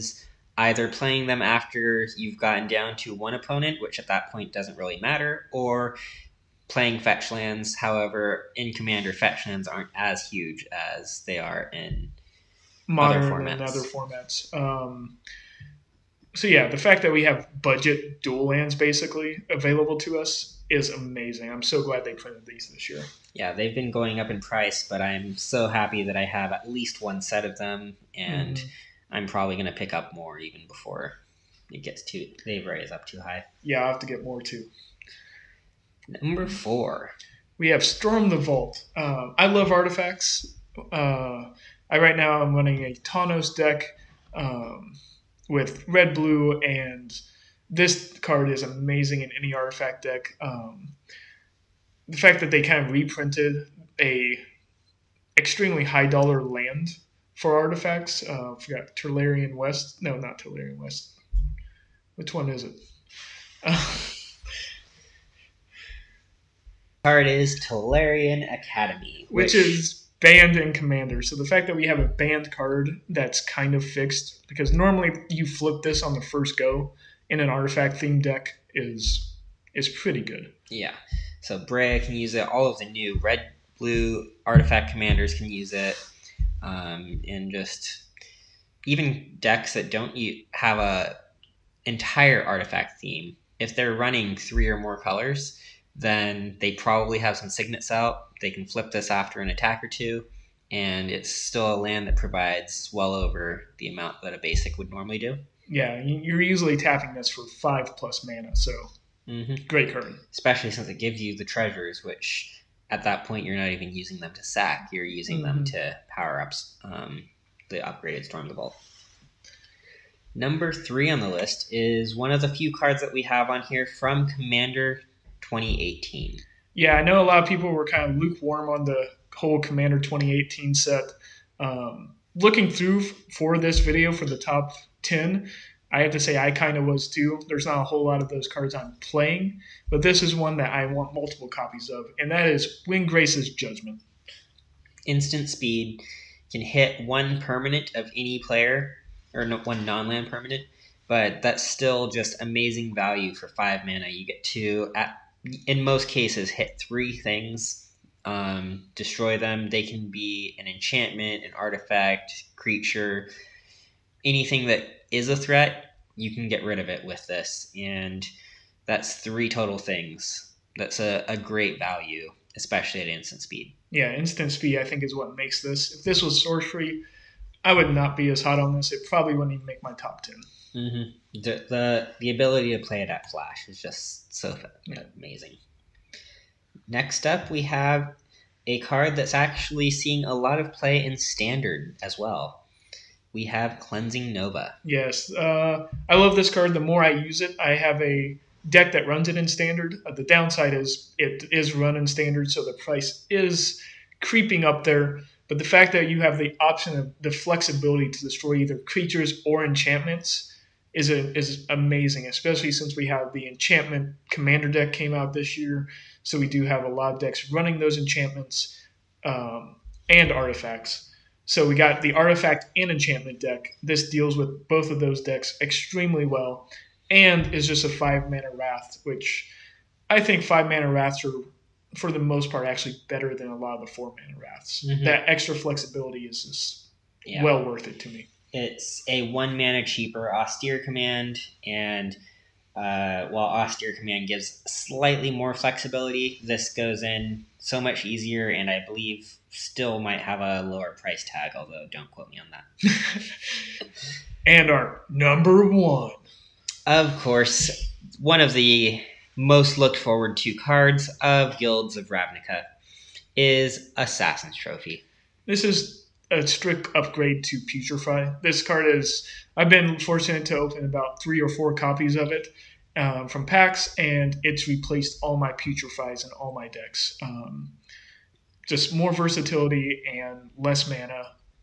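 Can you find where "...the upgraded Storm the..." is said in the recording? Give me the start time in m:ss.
1:57.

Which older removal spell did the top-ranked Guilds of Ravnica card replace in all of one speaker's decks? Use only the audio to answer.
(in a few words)
Putrefy.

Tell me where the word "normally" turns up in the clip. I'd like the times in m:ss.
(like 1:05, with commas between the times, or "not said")
1:14, 1:44.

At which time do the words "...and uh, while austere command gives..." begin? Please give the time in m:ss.
4:01.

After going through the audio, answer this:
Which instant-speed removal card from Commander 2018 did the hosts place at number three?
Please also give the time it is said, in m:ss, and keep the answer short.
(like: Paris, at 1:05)
Windgrace's Judgment, at 2:22.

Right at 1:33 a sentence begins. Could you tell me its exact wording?
If they're running three or more colors, then they probably have some signets out.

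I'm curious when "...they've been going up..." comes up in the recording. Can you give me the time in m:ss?
0:23.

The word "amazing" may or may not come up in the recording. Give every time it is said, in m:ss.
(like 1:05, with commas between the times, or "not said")
0:20, 0:48, 2:32, 3:05, 3:31.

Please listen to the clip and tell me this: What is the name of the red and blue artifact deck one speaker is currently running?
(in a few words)
Tanos.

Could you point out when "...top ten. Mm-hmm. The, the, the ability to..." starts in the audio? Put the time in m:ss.
2:59.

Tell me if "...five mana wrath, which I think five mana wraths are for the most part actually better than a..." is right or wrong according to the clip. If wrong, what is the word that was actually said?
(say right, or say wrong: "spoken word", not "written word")
right.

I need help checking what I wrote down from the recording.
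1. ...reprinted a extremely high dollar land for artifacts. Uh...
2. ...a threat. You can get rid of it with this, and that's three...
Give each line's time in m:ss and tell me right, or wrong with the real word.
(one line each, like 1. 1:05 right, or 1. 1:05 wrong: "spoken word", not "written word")
1. 0:52 right
2. 2:45 right.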